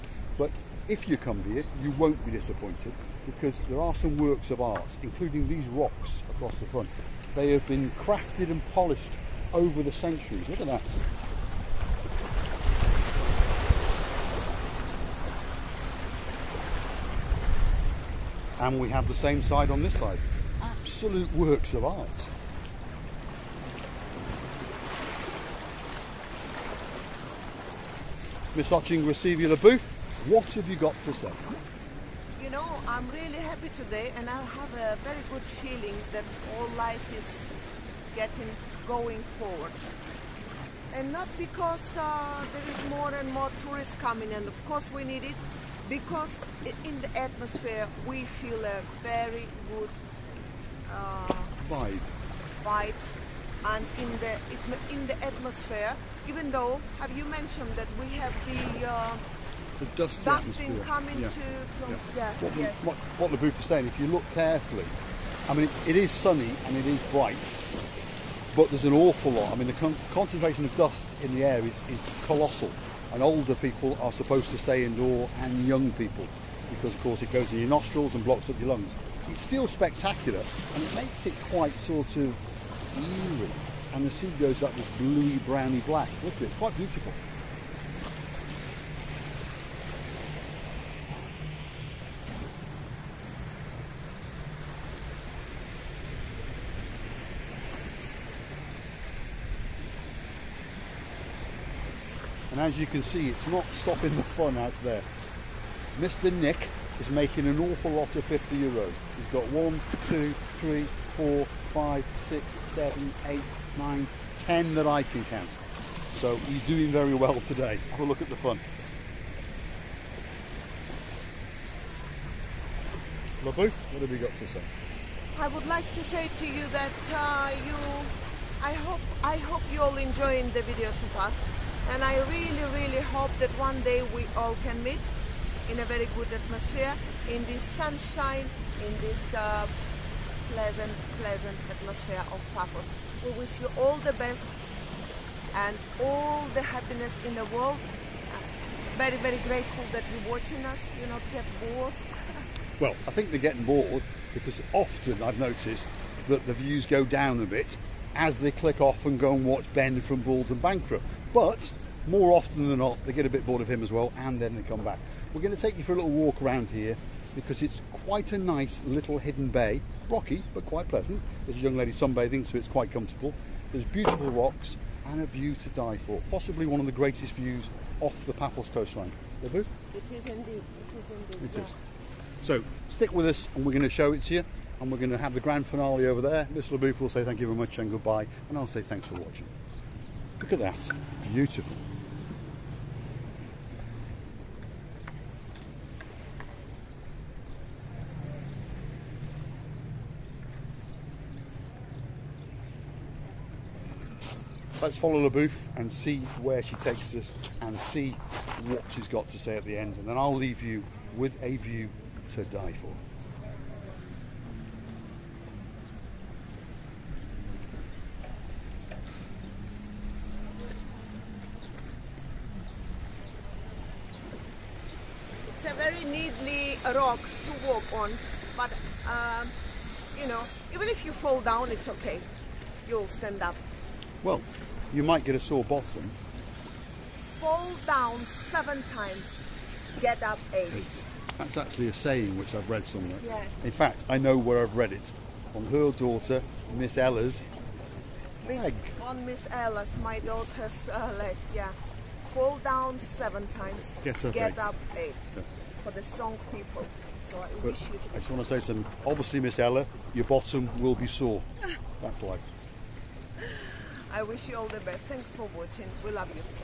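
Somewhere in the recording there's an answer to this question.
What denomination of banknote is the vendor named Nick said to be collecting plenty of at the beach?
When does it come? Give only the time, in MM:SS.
01:48.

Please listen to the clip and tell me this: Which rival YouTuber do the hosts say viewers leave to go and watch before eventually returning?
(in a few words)
Ben from Bald and Bankrupt.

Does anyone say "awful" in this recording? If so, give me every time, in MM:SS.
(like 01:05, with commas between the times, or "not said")
01:08, 01:47.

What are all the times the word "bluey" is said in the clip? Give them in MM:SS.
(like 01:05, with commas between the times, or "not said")
01:24.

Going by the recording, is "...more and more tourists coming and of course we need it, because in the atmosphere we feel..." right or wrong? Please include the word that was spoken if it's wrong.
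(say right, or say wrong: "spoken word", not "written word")
right.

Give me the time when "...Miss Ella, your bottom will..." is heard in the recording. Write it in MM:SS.
04:19.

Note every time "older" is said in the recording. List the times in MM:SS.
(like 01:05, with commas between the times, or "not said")
01:13.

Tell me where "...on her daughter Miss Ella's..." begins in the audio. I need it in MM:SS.
04:05.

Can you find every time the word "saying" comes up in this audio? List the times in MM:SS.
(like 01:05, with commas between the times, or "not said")
01:03, 04:01.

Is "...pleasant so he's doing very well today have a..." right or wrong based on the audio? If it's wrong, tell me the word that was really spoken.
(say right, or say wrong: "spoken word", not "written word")
wrong: "count", not "pleasant".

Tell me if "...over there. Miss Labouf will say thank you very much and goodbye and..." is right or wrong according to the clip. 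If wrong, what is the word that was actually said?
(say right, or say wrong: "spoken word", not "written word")
right.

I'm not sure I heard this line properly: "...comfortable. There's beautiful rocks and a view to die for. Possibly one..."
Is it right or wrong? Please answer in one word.
right.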